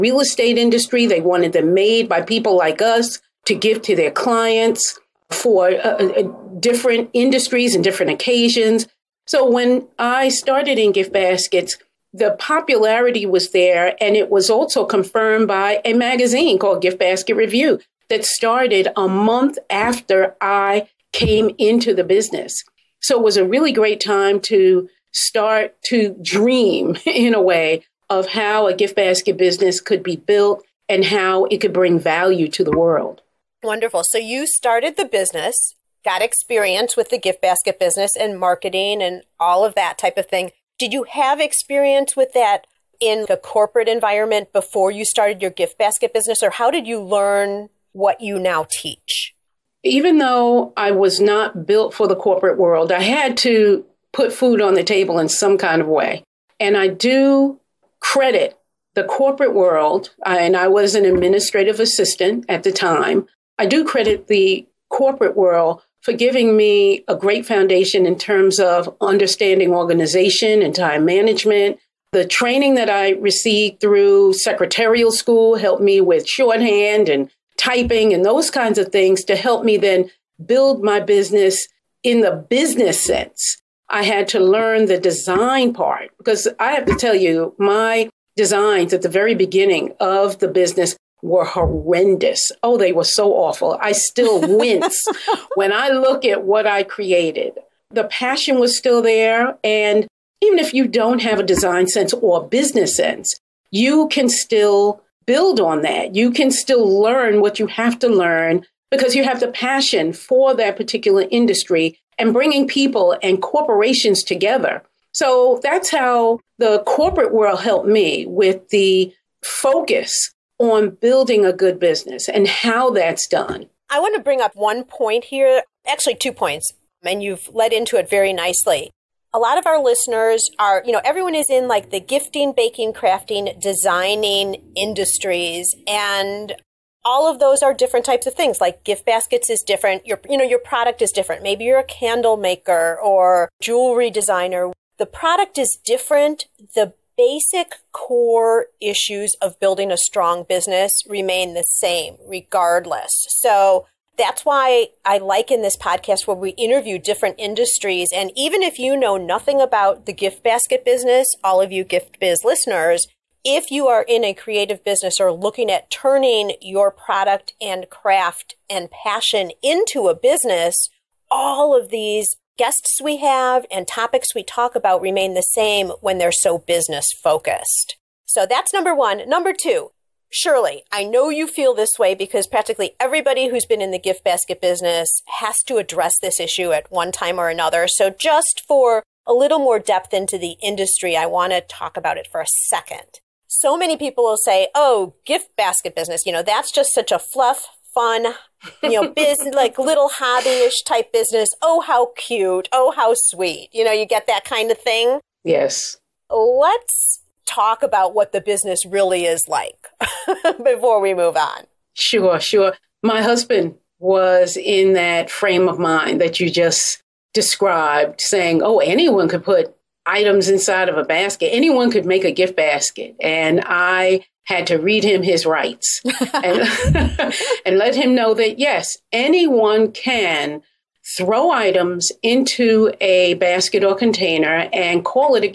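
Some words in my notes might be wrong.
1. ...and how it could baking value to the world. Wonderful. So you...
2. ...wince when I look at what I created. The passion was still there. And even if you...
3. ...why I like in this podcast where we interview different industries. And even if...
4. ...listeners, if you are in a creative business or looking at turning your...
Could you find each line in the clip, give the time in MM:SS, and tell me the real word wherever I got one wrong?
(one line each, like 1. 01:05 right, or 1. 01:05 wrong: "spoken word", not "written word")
1. 00:30 wrong: "bring", not "baking"
2. 01:34 right
3. 02:34 right
4. 02:42 right.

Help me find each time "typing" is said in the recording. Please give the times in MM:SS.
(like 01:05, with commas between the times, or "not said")
01:17.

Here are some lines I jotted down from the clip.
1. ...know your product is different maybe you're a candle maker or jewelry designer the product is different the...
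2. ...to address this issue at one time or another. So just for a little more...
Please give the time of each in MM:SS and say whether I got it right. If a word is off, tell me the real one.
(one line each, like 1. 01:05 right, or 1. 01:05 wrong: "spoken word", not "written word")
1. 02:20 right
2. 03:05 right.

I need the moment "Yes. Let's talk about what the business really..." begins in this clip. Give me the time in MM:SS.
03:25.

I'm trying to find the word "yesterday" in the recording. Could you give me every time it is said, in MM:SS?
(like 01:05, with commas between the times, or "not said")
not said.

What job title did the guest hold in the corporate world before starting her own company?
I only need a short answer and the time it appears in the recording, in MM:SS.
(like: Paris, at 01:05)
administrative assistant, at 01:01.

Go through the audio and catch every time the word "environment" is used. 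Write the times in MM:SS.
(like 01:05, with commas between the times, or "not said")
00:43.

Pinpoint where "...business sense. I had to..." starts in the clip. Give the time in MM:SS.
01:22.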